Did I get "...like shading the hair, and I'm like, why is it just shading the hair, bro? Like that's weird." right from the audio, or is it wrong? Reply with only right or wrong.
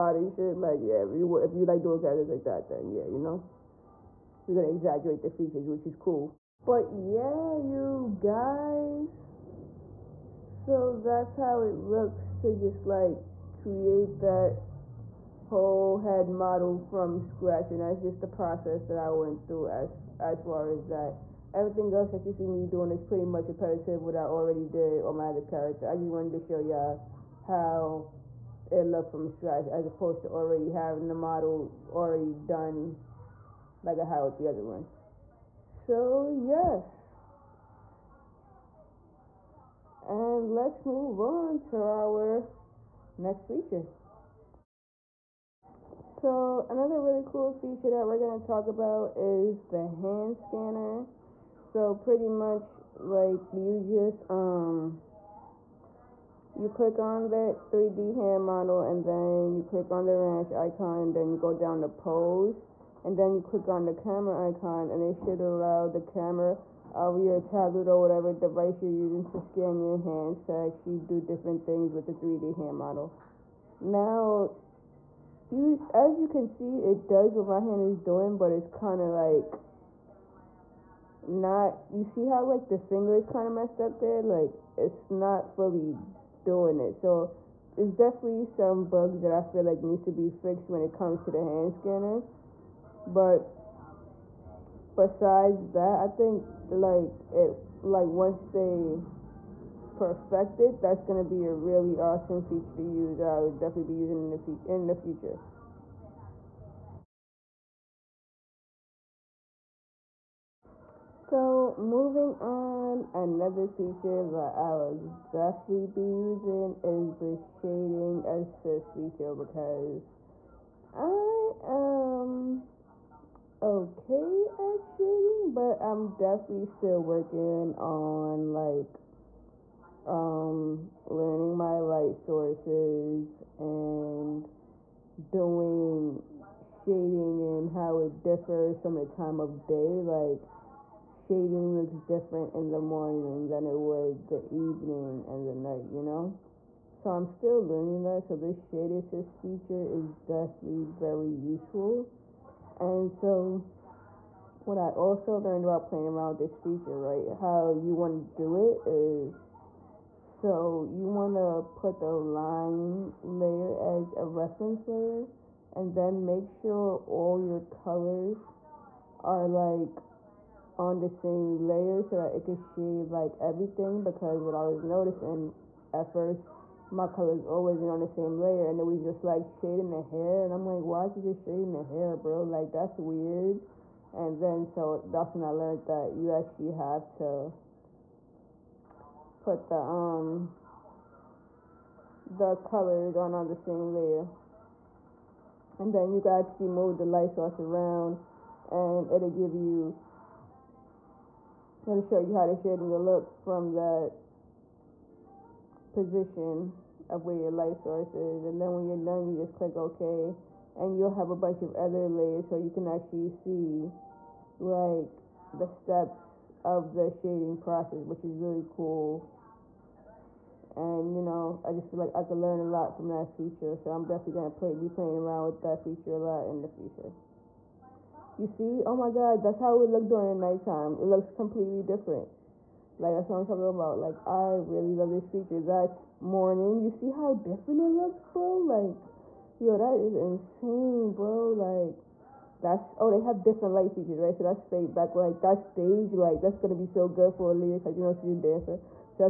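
right.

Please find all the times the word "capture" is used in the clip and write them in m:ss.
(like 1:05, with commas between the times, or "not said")
not said.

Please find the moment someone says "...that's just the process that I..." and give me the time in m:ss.
0:17.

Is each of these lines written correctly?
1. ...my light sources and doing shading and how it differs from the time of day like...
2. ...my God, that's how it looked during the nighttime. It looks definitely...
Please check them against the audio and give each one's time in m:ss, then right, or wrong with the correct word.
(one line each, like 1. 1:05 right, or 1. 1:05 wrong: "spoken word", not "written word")
1. 2:11 right
2. 3:48 wrong: "completely", not "definitely".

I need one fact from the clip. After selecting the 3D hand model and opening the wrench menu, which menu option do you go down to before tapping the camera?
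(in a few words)
Pose.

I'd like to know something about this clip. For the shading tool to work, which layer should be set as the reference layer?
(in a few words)
The line layer.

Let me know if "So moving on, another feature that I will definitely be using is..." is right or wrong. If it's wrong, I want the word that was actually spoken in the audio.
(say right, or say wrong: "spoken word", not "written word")
right.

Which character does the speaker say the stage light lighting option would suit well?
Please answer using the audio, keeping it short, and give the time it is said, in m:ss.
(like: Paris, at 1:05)
Aaliyah, at 4:07.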